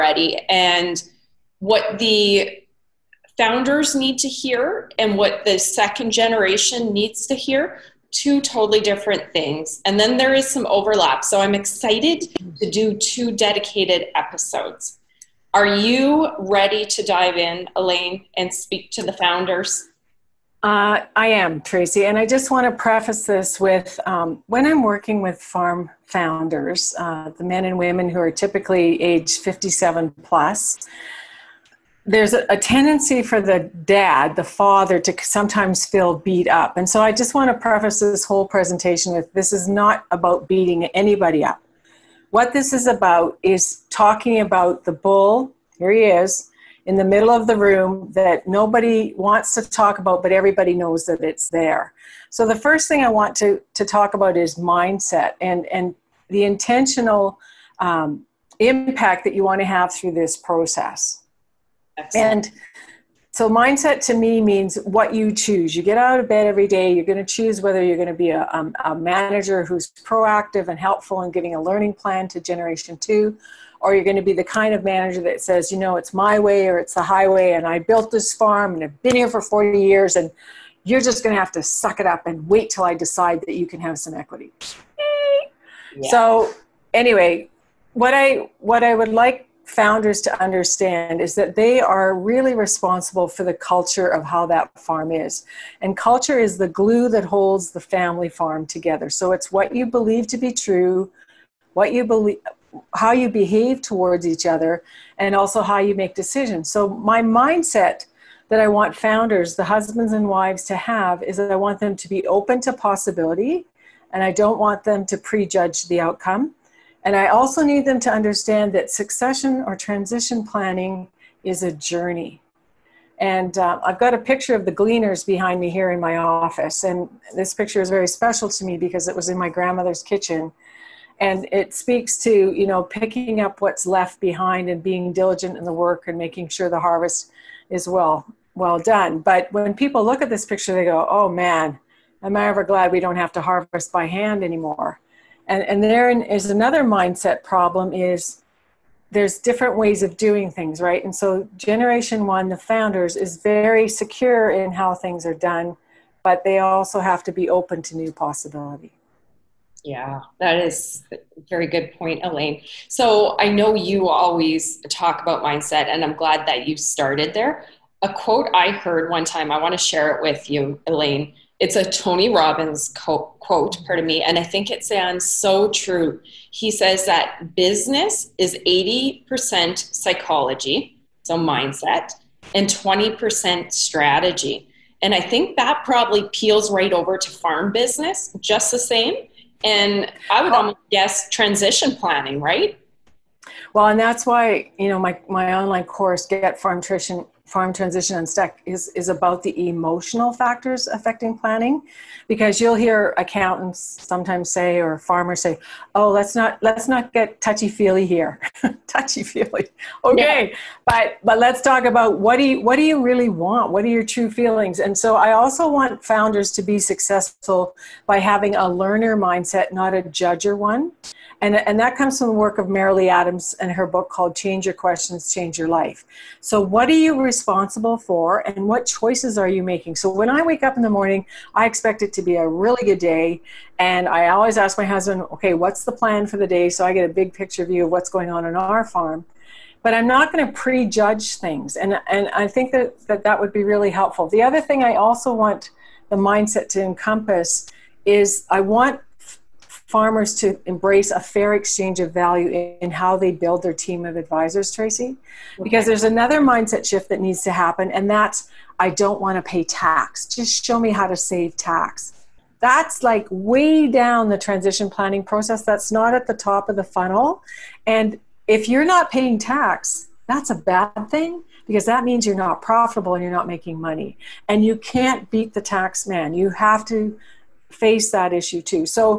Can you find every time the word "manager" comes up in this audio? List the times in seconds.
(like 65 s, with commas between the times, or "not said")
68 s, 74 s.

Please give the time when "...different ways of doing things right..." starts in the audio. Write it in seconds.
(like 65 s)
149 s.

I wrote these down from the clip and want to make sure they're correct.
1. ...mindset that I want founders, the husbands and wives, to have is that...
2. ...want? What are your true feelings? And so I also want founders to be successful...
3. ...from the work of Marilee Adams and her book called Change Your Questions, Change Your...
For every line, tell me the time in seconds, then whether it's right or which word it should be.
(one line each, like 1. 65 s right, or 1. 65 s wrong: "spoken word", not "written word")
1. 107 s right
2. 213 s right
3. 222 s right.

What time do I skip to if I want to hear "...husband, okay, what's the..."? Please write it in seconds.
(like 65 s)
234 s.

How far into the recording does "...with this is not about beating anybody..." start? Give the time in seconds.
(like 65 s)
39 s.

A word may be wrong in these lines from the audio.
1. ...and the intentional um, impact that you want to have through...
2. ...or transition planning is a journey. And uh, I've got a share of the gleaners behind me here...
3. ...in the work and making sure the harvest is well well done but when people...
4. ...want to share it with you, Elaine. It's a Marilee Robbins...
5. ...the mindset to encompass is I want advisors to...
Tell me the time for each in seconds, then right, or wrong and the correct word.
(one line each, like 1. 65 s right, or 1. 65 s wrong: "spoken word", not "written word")
1. 55 s right
2. 119 s wrong: "picture", not "share"
3. 135 s right
4. 169 s wrong: "Tony", not "Marilee"
5. 246 s wrong: "farmers", not "advisors".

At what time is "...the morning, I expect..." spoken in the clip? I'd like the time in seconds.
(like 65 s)
230 s.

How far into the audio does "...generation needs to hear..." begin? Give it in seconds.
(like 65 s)
6 s.